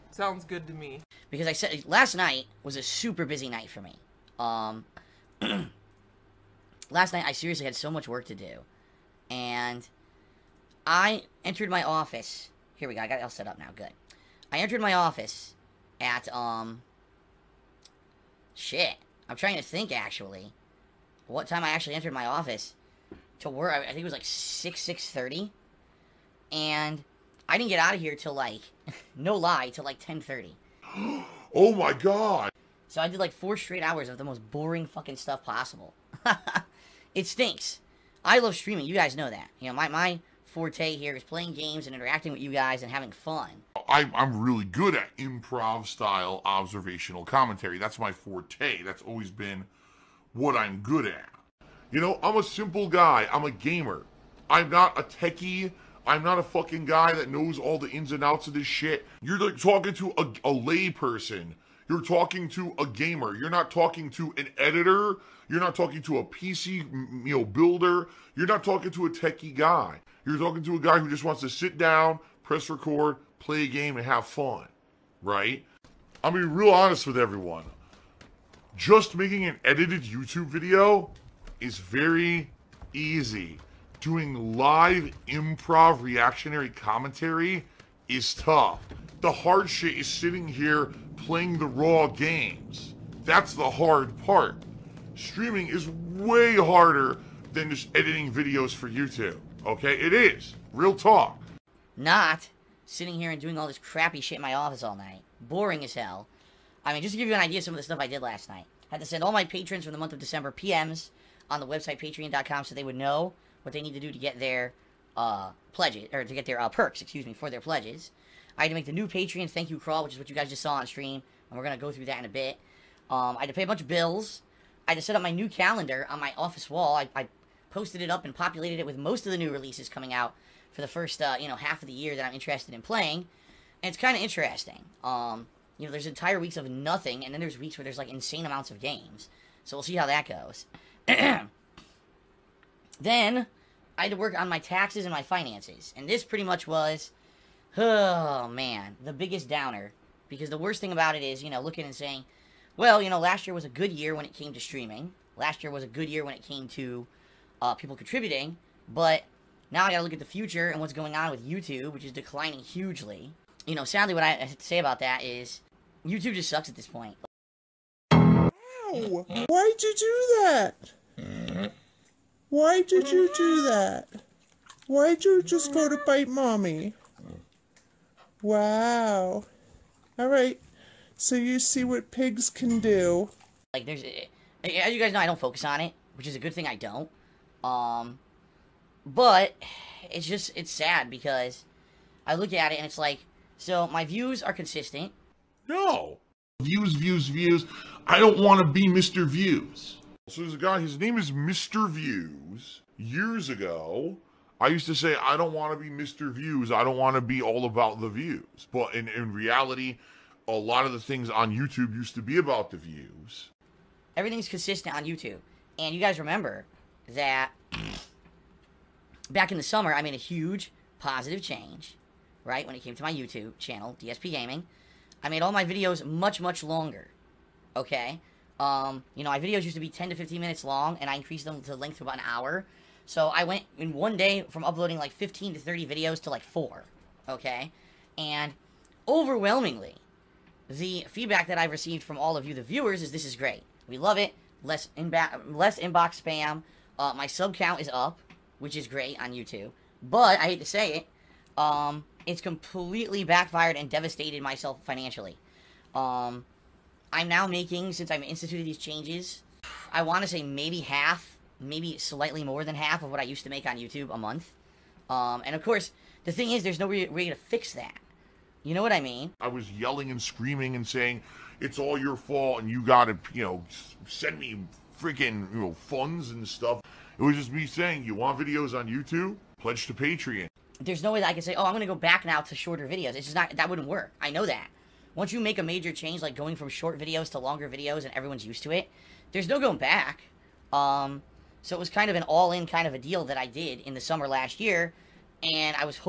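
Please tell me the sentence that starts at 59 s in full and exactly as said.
You're like talking to a, a lay person you're talking to a gamer.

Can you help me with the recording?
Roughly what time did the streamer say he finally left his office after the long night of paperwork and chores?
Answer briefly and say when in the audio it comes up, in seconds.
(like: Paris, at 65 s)
10:30, at 29 s.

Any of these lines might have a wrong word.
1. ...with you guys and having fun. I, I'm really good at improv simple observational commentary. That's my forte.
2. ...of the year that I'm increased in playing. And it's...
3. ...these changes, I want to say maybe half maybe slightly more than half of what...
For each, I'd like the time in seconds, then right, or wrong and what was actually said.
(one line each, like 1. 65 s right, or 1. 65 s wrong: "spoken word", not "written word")
1. 42 s wrong: "style", not "simple"
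2. 131 s wrong: "interested", not "increased"
3. 258 s right.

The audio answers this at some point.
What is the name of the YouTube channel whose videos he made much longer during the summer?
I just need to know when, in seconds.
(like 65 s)
224 s.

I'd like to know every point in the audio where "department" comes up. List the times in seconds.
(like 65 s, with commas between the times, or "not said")
not said.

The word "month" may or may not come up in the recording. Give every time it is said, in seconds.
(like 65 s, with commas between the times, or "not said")
109 s, 264 s.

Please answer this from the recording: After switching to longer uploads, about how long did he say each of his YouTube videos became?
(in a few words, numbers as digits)
about an hour.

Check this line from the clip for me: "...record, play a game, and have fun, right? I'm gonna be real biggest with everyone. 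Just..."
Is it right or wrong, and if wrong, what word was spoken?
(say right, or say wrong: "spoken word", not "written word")
wrong: "honest", not "biggest".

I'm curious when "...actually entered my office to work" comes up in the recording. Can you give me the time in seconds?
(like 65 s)
21 s.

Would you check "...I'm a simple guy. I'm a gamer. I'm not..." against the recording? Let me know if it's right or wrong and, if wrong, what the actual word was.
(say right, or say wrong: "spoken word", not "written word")
right.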